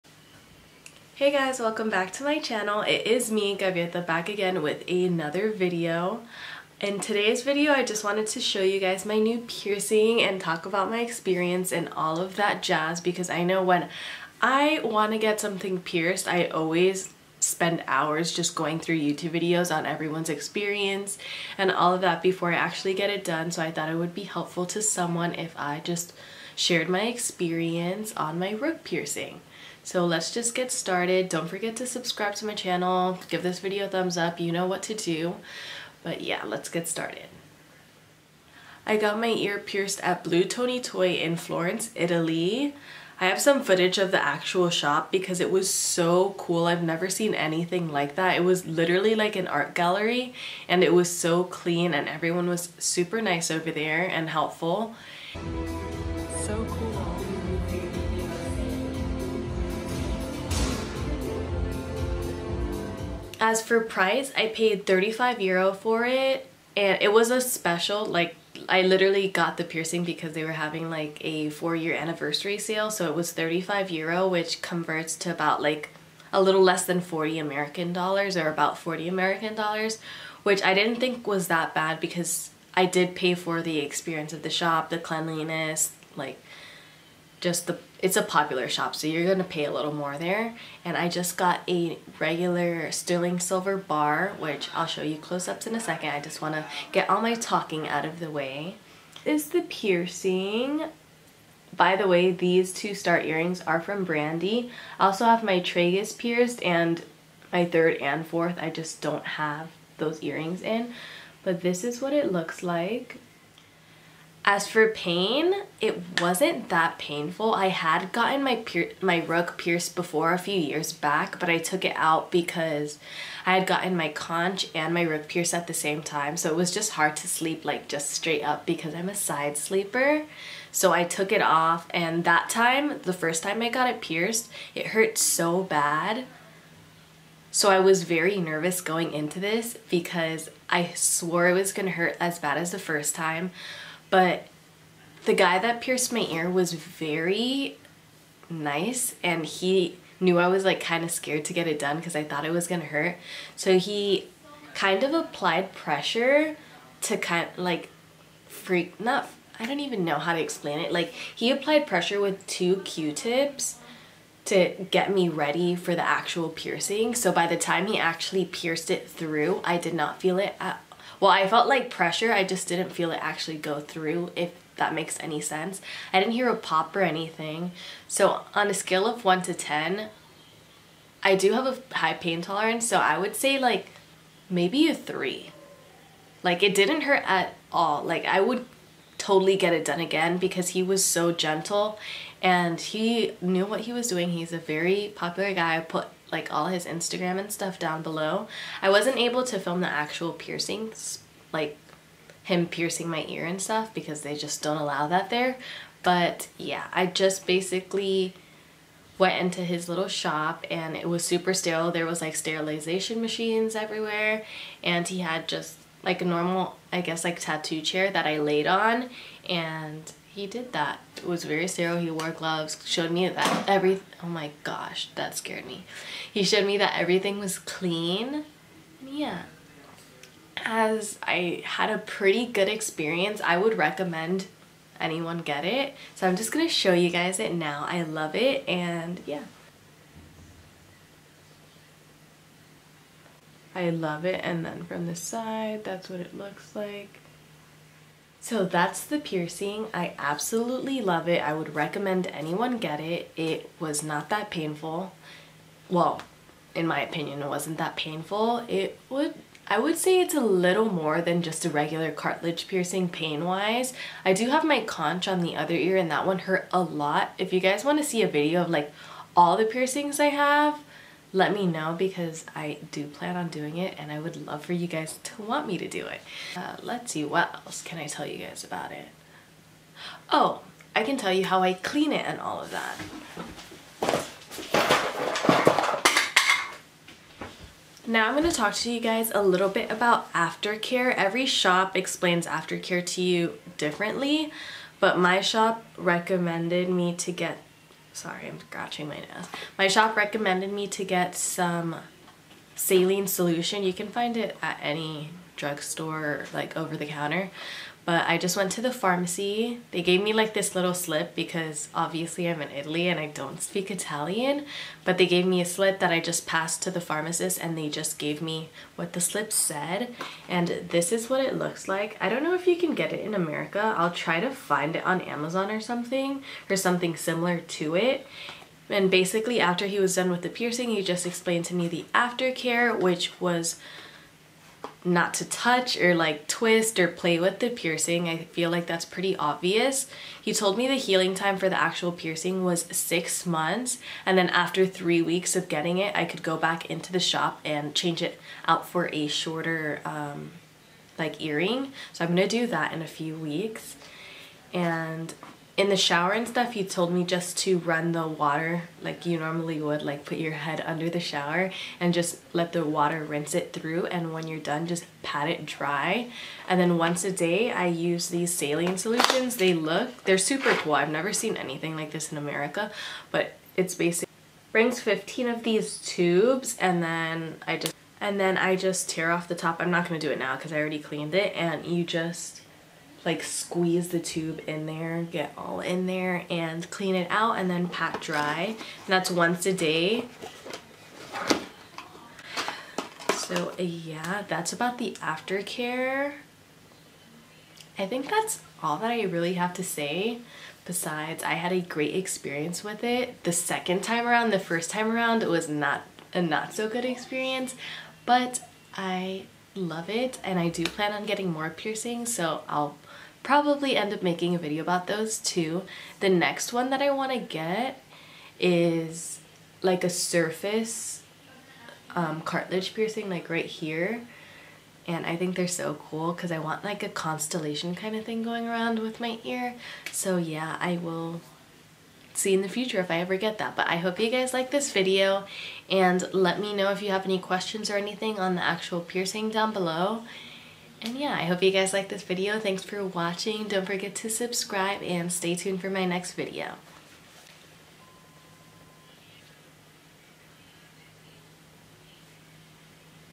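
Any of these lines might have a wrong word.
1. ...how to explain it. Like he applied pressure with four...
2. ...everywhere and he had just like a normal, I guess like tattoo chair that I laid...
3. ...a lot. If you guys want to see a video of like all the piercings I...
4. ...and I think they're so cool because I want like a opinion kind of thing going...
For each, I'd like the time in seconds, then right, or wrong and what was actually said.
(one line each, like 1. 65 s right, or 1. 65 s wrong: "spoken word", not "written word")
1. 160 s wrong: "two", not "four"
2. 213 s right
3. 266 s right
4. 425 s wrong: "constellation", not "opinion".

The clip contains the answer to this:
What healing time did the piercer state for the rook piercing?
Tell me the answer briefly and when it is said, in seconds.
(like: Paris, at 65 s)
Six months, at 342 s.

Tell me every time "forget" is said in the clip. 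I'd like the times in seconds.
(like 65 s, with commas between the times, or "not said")
31 s, 443 s.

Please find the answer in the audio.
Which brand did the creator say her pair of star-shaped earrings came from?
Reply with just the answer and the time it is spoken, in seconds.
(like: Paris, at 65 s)
Brandy, at 104 s.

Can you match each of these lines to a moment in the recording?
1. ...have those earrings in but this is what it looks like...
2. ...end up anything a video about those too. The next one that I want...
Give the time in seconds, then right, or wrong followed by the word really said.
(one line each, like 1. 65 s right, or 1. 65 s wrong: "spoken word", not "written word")
1. 109 s right
2. 413 s wrong: "making", not "anything".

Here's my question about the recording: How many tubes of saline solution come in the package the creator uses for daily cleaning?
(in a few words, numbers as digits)
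15.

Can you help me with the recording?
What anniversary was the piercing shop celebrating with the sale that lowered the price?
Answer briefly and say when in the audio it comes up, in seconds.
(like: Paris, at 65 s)
Four year anniversary, at 71 s.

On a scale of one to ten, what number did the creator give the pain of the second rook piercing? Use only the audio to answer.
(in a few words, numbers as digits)
3.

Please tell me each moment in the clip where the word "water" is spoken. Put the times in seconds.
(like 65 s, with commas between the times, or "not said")
358 s, 362 s.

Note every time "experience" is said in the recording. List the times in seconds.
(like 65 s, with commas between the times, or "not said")
11 s, 20 s, 27 s, 83 s, 232 s, 402 s, 407 s.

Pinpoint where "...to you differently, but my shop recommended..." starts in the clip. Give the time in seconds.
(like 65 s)
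293 s.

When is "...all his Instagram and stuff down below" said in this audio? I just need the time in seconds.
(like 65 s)
196 s.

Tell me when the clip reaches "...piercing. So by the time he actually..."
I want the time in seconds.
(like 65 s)
166 s.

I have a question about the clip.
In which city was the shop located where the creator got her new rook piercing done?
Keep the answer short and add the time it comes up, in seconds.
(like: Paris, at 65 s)
Florence, Italy, at 41 s.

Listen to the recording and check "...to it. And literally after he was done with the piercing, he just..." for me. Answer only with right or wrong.
wrong.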